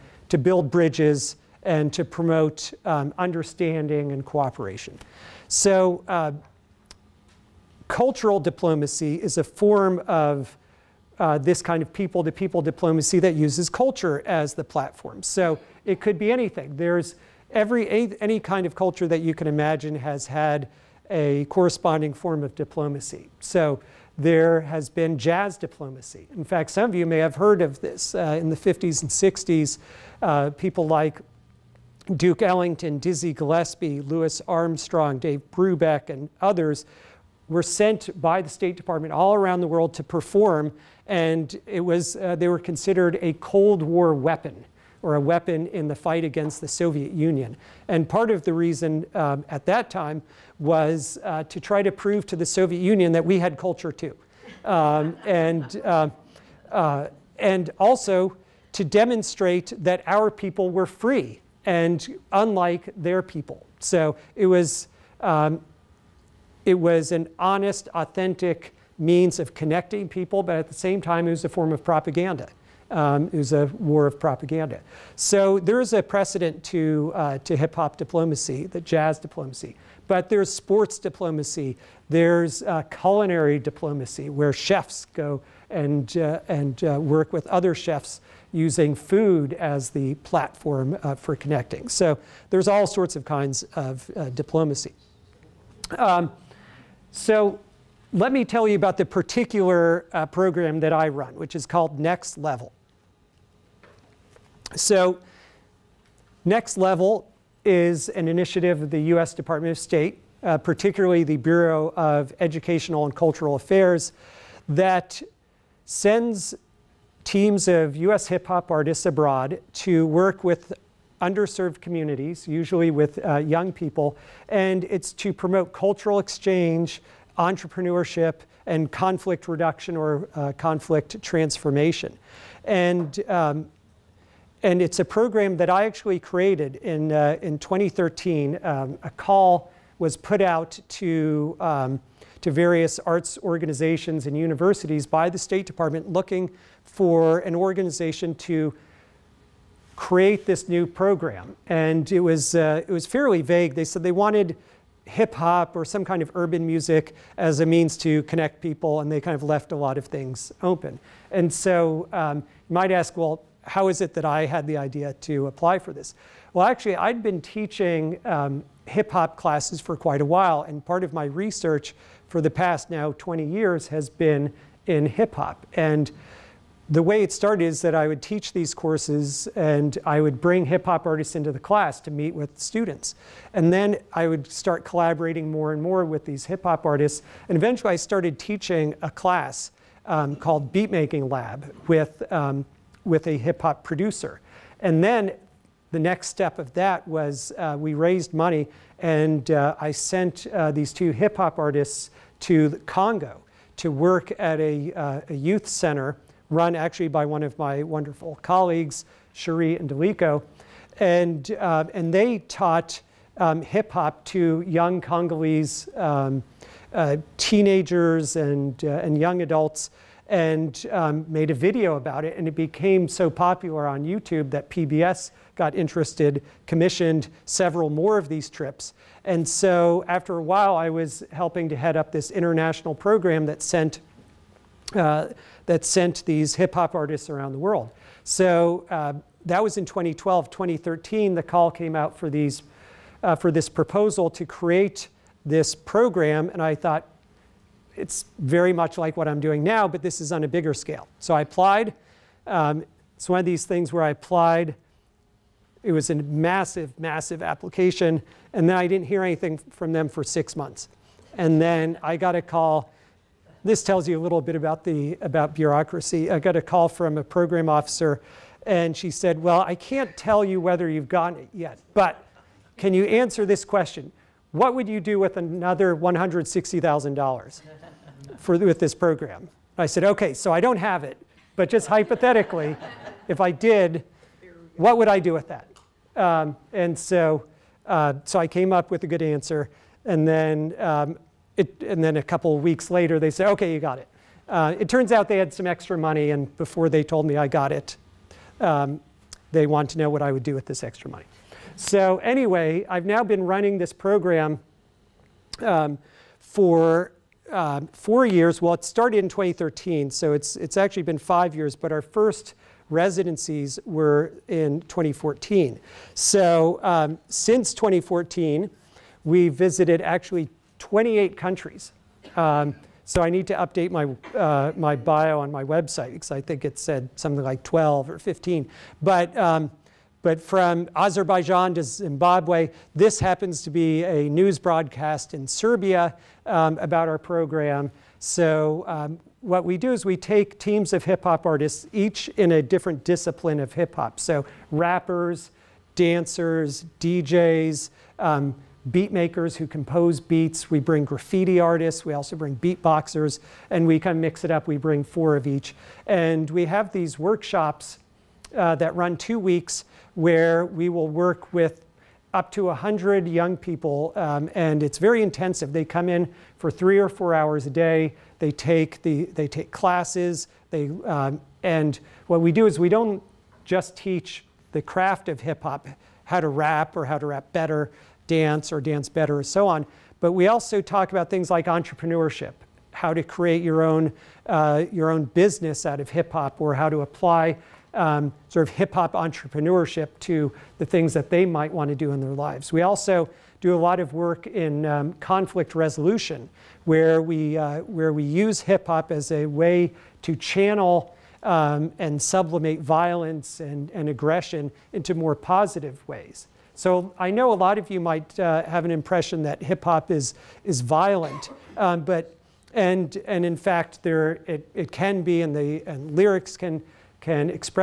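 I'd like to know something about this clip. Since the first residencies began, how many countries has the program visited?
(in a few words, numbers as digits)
28.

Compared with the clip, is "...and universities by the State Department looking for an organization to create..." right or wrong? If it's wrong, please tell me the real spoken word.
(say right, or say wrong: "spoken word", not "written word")
right.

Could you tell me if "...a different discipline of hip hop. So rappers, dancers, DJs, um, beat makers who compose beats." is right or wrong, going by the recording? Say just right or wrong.
right.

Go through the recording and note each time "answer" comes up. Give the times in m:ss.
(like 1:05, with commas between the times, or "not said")
4:33, 4:49.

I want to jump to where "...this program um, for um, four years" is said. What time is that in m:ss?
5:03.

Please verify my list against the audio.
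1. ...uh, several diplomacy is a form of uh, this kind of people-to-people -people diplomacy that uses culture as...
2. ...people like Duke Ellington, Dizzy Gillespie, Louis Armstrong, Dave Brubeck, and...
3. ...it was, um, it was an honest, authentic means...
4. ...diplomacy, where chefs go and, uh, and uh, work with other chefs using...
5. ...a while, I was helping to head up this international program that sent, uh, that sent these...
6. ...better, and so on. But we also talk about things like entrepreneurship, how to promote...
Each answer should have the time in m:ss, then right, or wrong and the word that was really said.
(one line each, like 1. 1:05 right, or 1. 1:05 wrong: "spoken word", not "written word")
1. 0:06 wrong: "cultural", not "several"
2. 0:30 right
3. 1:04 right
4. 1:23 right
5. 3:50 right
6. 6:19 wrong: "create", not "promote".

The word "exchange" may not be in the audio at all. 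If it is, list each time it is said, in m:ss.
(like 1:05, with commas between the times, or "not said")
2:06.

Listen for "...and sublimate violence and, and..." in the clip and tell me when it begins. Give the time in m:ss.
6:41.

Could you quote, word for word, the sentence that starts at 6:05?
They come in for three or four hours a day.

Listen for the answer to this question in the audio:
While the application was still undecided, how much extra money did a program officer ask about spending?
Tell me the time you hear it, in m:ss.
4:35.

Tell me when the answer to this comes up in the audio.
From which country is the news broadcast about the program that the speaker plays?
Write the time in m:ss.
5:35.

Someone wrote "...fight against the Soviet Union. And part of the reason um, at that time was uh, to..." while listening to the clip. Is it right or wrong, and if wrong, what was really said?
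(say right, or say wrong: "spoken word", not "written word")
right.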